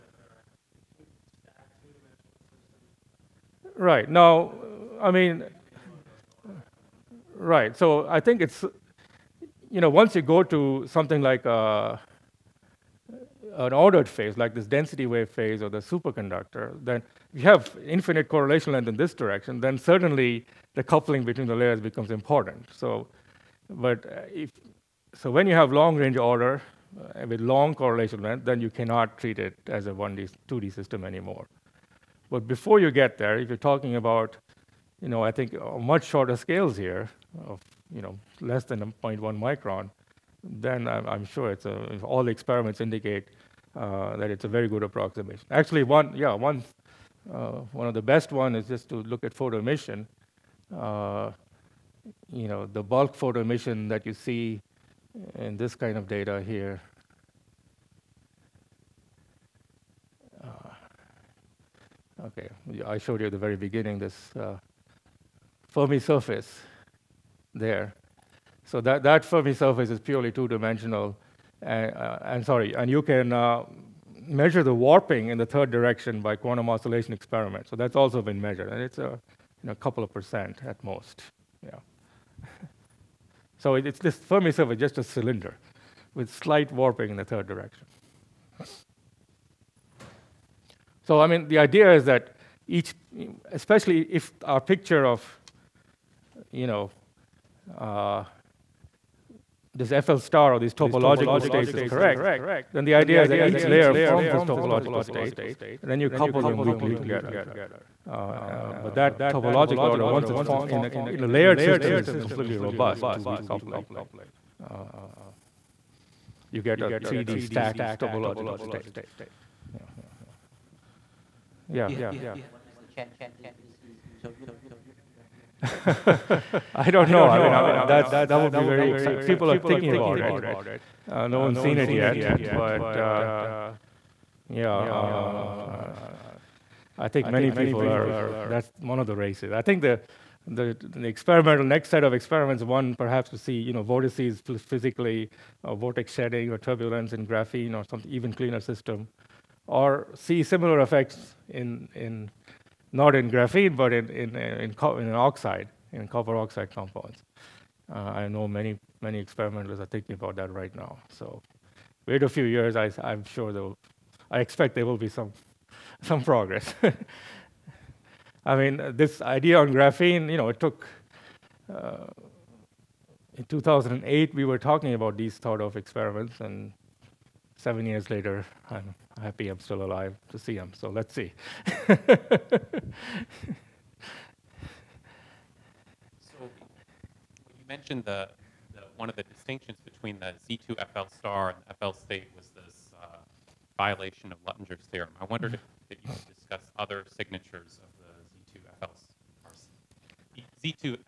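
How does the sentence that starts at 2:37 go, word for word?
Uh, I know many, many experimenters are thinking about that right now.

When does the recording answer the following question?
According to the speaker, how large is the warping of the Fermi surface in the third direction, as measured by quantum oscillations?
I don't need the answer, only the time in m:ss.
1:19.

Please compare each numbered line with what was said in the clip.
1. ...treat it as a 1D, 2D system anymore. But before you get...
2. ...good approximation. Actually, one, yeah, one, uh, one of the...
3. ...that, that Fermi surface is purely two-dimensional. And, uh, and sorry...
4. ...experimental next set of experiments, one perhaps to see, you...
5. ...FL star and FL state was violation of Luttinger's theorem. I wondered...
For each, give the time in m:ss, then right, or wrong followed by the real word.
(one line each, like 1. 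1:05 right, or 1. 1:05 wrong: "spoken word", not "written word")
1. 0:29 right
2. 0:44 right
3. 1:08 right
4. 2:21 right
5. 3:10 right.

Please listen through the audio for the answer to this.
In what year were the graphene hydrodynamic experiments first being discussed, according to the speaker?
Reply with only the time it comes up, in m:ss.
2:53.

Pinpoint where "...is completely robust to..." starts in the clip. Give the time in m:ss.
1:51.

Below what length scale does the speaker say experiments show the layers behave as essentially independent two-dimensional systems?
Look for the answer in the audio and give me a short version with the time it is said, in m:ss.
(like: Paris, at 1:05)
0.1 micron, at 0:39.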